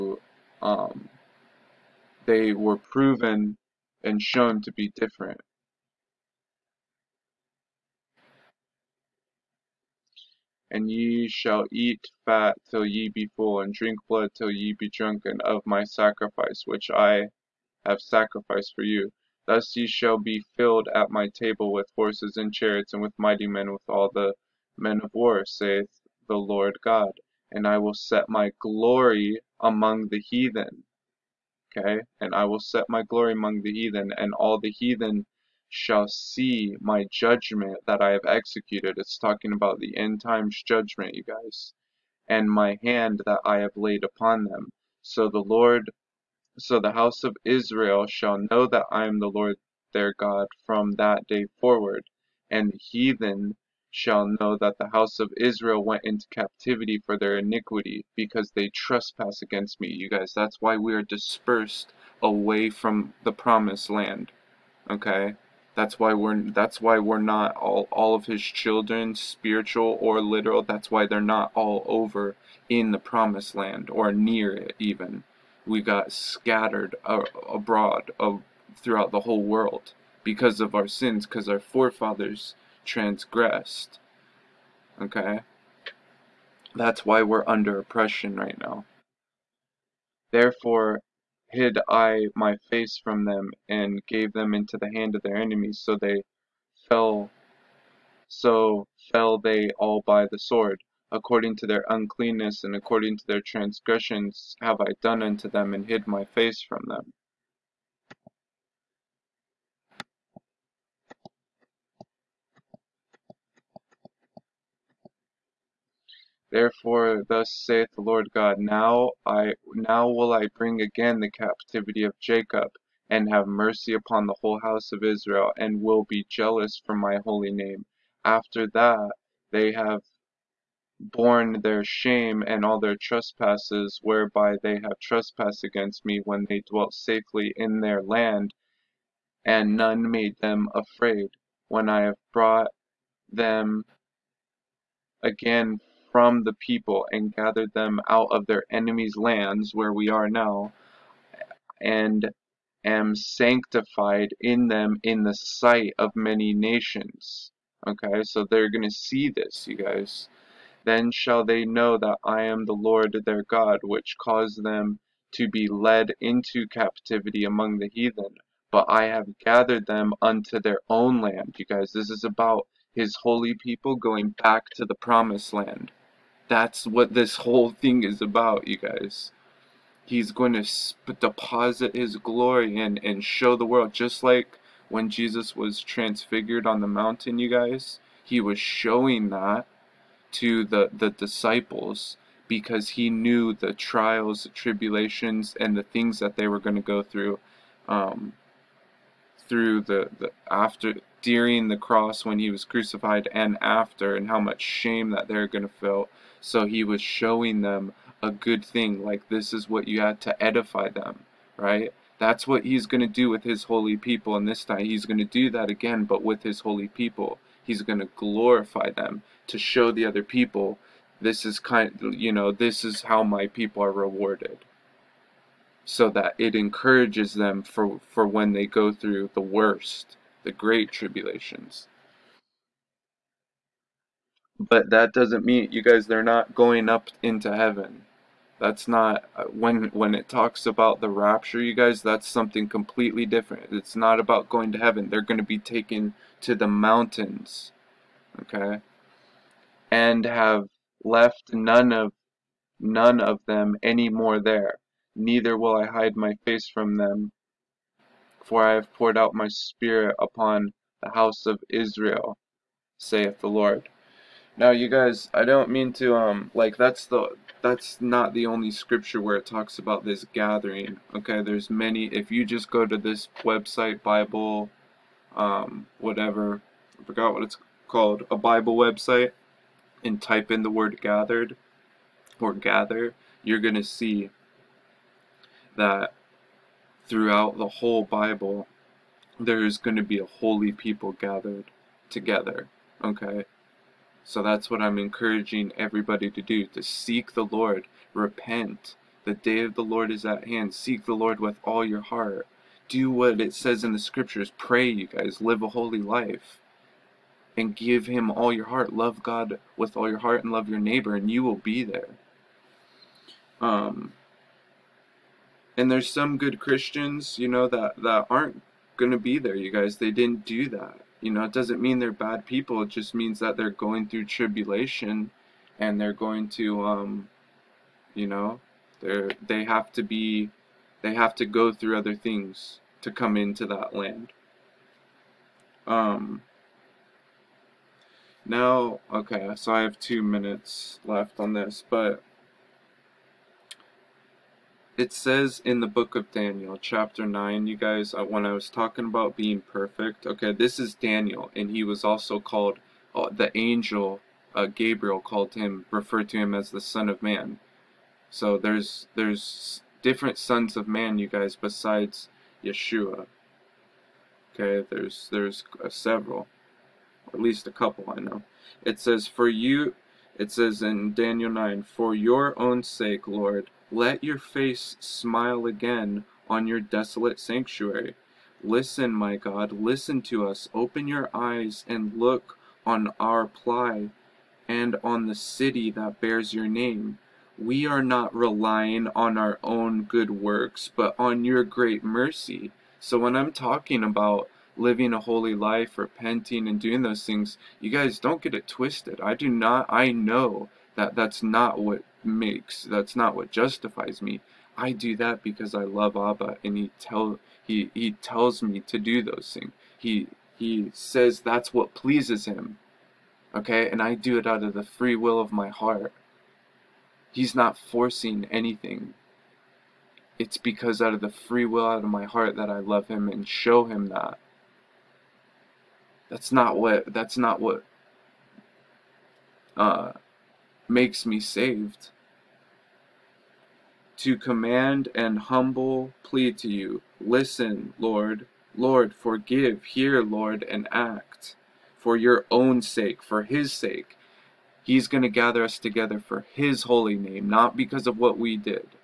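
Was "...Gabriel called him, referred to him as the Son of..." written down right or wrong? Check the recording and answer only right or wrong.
right.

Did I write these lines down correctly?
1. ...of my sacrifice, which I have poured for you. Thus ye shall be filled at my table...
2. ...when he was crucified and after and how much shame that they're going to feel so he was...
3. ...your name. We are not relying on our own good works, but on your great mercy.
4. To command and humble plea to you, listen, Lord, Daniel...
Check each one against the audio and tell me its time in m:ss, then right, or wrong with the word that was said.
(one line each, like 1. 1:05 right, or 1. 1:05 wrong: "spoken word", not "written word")
1. 0:15 wrong: "sacrificed", not "poured"
2. 3:22 right
3. 6:26 right
4. 7:14 wrong: "Lord", not "Daniel".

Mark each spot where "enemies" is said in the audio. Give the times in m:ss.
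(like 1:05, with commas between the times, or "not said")
1:35, 2:28.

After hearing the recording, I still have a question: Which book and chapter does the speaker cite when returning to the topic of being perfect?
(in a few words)
Daniel 9.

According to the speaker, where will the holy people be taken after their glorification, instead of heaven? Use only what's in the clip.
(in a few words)
The mountains.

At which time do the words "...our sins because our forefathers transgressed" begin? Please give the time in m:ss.
1:20.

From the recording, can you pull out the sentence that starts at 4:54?
So that's what I'm encouraging everybody to do to seek the Lord, repent.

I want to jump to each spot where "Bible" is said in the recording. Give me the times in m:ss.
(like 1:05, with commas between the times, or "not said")
4:34, 4:38, 4:48.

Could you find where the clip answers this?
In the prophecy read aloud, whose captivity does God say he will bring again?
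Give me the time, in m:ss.
2:01.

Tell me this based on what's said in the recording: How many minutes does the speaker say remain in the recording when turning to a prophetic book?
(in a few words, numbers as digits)
2.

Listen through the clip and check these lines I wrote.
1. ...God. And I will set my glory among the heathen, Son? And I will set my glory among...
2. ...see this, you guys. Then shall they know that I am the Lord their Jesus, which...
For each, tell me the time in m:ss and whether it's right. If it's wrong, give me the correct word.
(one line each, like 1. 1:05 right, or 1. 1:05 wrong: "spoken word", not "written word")
1. 0:26 wrong: "Okay", not "Son"
2. 2:38 wrong: "God", not "Jesus".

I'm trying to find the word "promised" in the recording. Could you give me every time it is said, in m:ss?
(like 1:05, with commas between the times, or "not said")
1:03, 1:12, 2:54.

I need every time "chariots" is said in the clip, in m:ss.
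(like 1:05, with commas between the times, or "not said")
0:22.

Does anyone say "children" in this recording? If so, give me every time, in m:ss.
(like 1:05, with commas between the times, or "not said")
1:08.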